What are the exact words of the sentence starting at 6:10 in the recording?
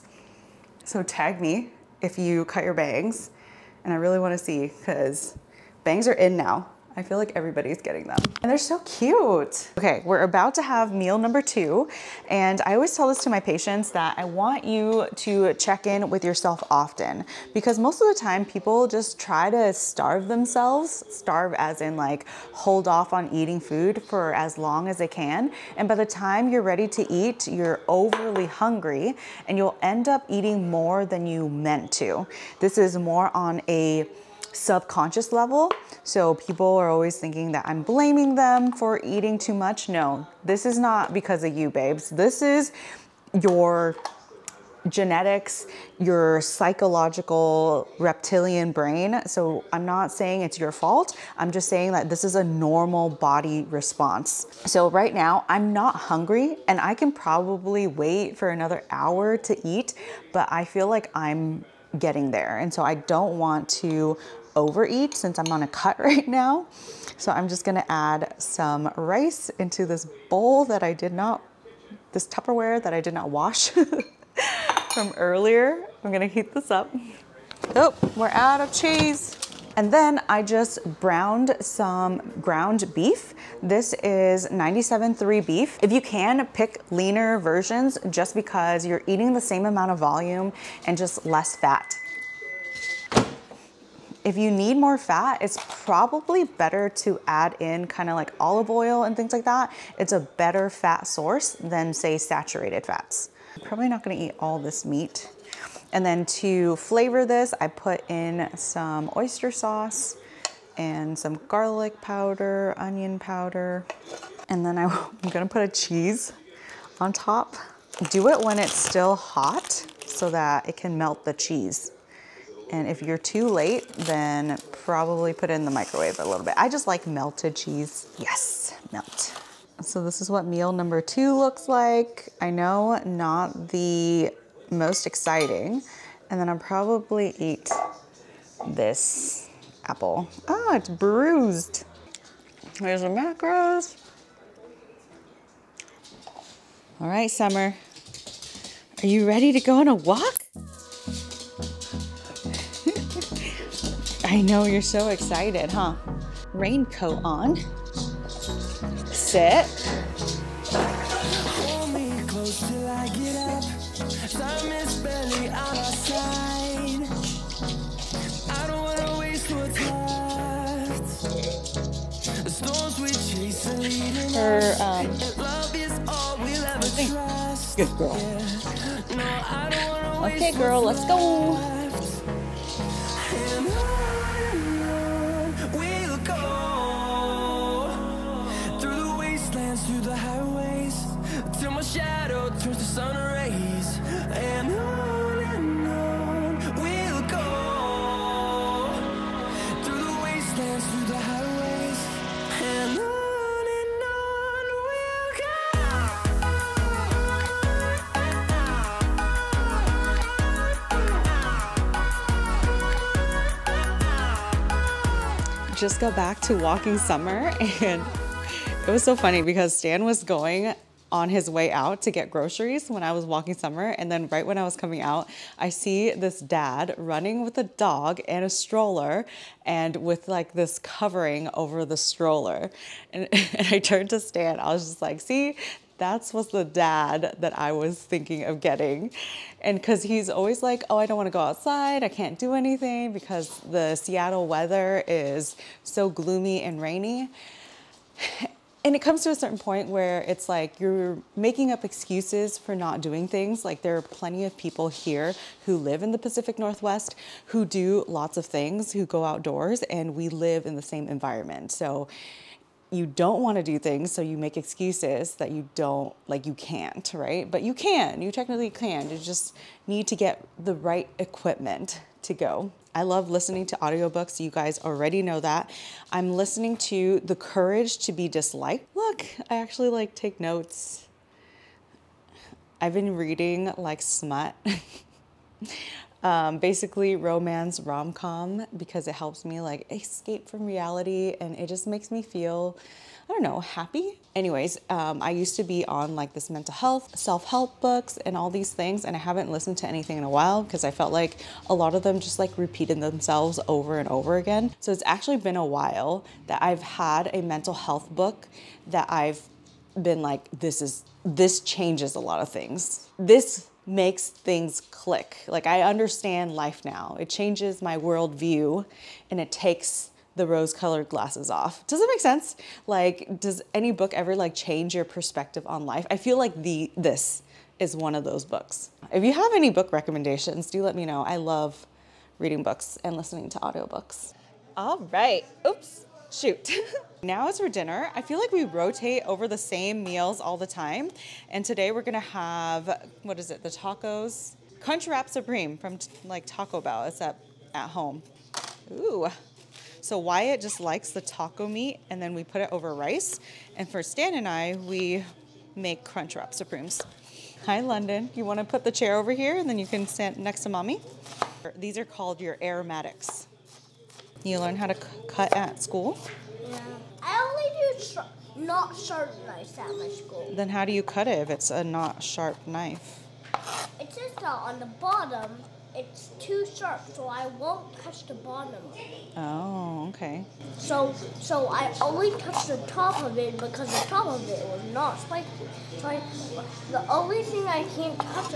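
Then how do you cut it if it's a not sharp knife?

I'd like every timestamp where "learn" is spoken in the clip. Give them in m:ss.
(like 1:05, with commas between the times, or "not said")
6:04.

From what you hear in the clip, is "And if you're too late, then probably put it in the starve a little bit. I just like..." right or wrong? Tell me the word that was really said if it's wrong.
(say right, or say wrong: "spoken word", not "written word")
wrong: "microwave", not "starve".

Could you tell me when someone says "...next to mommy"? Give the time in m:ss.
6:00.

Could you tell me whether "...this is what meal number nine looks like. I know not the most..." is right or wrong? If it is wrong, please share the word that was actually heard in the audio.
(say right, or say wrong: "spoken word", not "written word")
wrong: "two", not "nine".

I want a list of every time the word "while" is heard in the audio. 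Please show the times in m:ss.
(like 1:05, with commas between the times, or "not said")
5:00, 5:05.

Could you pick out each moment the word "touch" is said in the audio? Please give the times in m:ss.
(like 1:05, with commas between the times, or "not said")
6:18, 6:22.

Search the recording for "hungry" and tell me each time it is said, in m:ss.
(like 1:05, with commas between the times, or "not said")
0:28, 0:55.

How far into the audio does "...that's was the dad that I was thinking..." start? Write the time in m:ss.
3:55.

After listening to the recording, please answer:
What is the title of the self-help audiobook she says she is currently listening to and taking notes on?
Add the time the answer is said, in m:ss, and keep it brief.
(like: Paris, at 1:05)
The Courage to be Disliked, at 4:37.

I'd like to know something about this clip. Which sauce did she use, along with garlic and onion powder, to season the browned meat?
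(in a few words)
oyster sauce.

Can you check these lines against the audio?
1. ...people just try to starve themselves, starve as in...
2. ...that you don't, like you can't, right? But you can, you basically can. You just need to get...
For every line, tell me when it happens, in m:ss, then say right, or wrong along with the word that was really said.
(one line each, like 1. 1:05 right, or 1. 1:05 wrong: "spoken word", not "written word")
1. 0:18 right
2. 4:25 wrong: "technically", not "basically".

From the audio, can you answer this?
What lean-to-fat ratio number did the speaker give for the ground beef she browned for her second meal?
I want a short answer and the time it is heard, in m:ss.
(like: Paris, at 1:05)
97.3, at 1:24.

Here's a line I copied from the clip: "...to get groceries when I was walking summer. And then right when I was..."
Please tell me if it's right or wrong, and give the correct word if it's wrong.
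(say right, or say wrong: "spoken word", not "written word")
right.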